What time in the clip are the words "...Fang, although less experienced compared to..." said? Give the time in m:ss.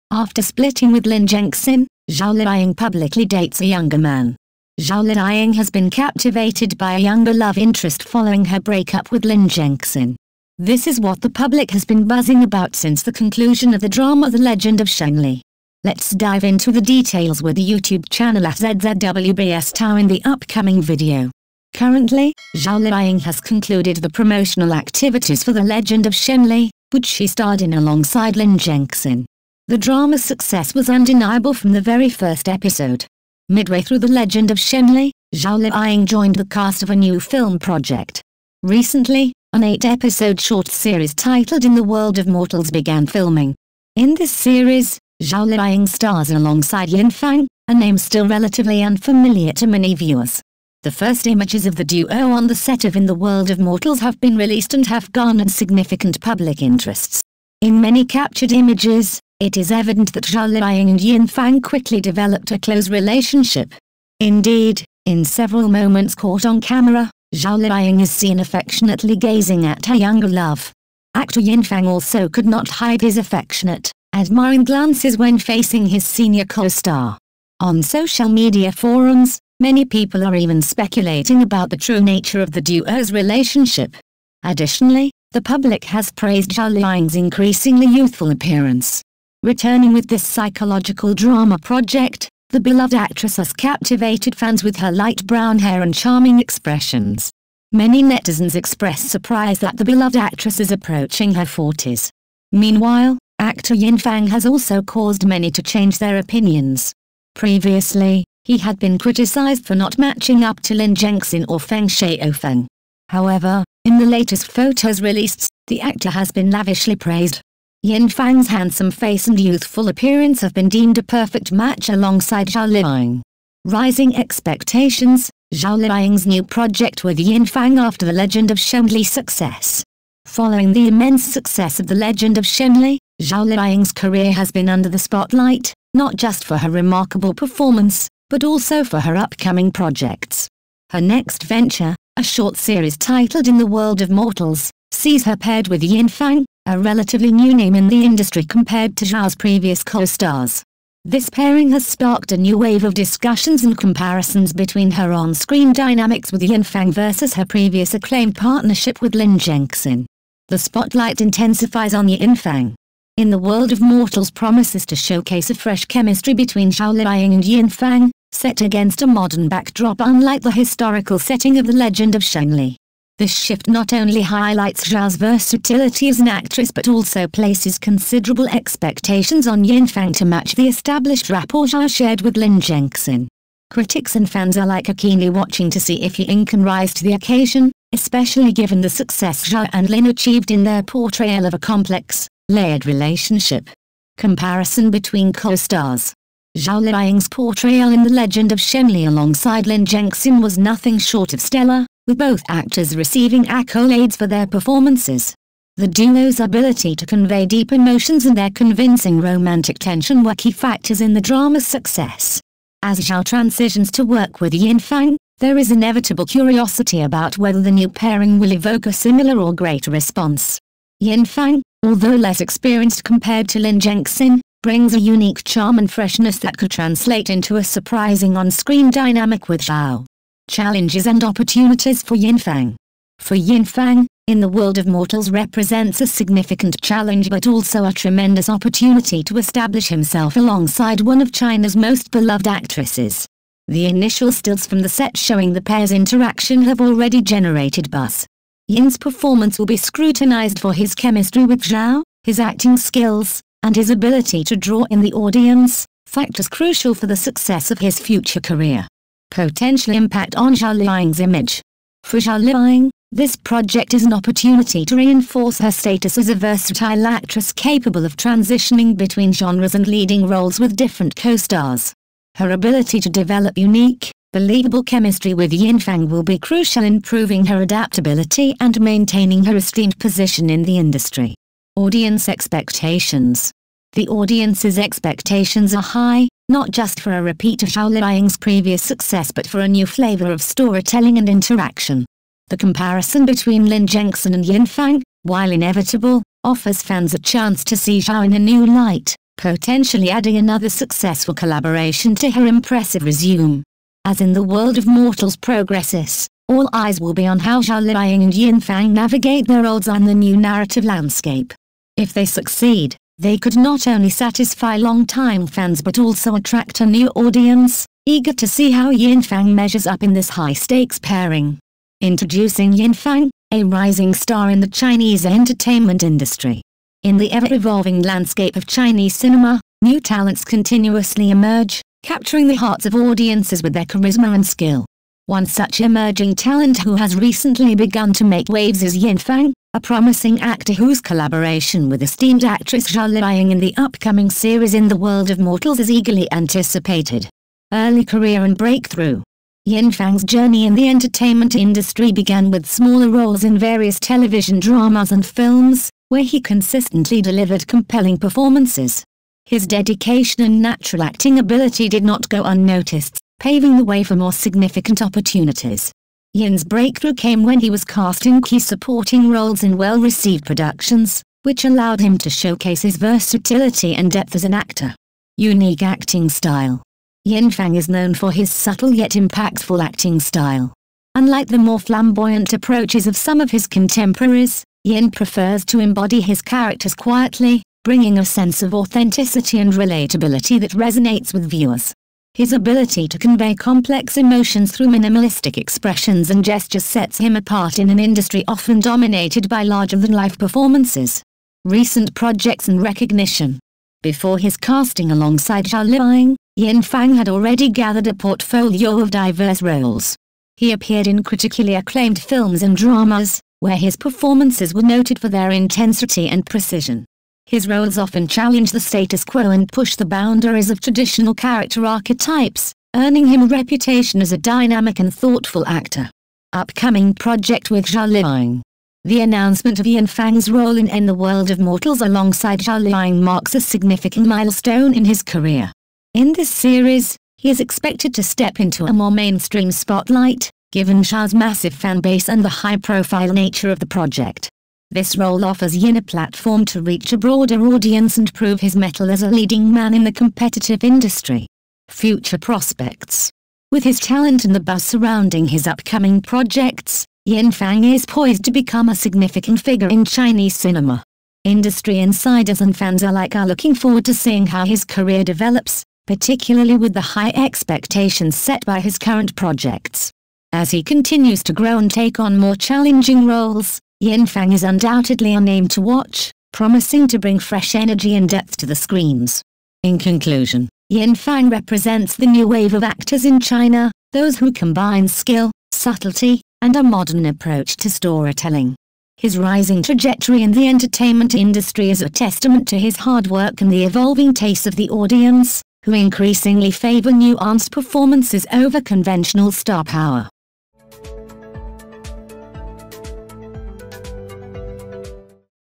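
3:41.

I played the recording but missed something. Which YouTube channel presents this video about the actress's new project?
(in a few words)
ZZWBS Tao.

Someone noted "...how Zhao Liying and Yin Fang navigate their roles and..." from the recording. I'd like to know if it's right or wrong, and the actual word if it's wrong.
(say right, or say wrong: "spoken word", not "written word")
right.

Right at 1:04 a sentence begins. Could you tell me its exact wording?
Indeed, in several moments caught on camera, Zhao Liying is seen affectionately gazing at her younger love.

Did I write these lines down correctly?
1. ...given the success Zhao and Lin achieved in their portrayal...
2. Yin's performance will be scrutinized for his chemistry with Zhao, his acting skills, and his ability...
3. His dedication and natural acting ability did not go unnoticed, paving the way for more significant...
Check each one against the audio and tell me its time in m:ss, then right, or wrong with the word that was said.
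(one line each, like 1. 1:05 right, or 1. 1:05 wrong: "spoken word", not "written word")
1. 3:08 right
2. 4:08 right
3. 5:59 right.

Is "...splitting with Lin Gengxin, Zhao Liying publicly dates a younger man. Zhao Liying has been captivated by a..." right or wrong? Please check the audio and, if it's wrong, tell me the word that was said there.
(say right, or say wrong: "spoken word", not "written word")
right.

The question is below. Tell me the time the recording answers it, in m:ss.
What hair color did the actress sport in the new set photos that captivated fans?
1:34.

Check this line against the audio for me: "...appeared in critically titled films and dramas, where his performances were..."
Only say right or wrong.
wrong.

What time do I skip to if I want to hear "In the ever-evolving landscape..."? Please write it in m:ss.
5:27.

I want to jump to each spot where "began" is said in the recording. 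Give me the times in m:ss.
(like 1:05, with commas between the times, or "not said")
0:42, 5:52.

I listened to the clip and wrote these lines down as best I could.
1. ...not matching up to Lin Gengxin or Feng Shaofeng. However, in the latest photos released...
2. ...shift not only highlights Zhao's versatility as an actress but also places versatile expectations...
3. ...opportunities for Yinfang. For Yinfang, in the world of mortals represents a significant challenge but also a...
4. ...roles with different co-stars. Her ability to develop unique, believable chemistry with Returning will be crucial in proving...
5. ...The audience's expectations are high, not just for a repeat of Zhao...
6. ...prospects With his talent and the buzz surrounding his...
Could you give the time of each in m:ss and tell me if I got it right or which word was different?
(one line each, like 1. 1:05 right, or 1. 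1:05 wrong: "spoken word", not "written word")
1. 1:49 right
2. 2:53 wrong: "considerable", not "versatile"
3. 3:51 right
4. 4:30 wrong: "Yinfang", not "Returning"
5. 4:43 right
6. 7:32 right.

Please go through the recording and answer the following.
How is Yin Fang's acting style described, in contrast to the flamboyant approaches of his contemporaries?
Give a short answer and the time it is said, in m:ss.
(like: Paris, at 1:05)
subtle yet impactful, at 6:18.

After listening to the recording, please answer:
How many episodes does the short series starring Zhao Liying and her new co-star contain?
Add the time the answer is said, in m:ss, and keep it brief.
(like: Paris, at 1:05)
8, at 0:39.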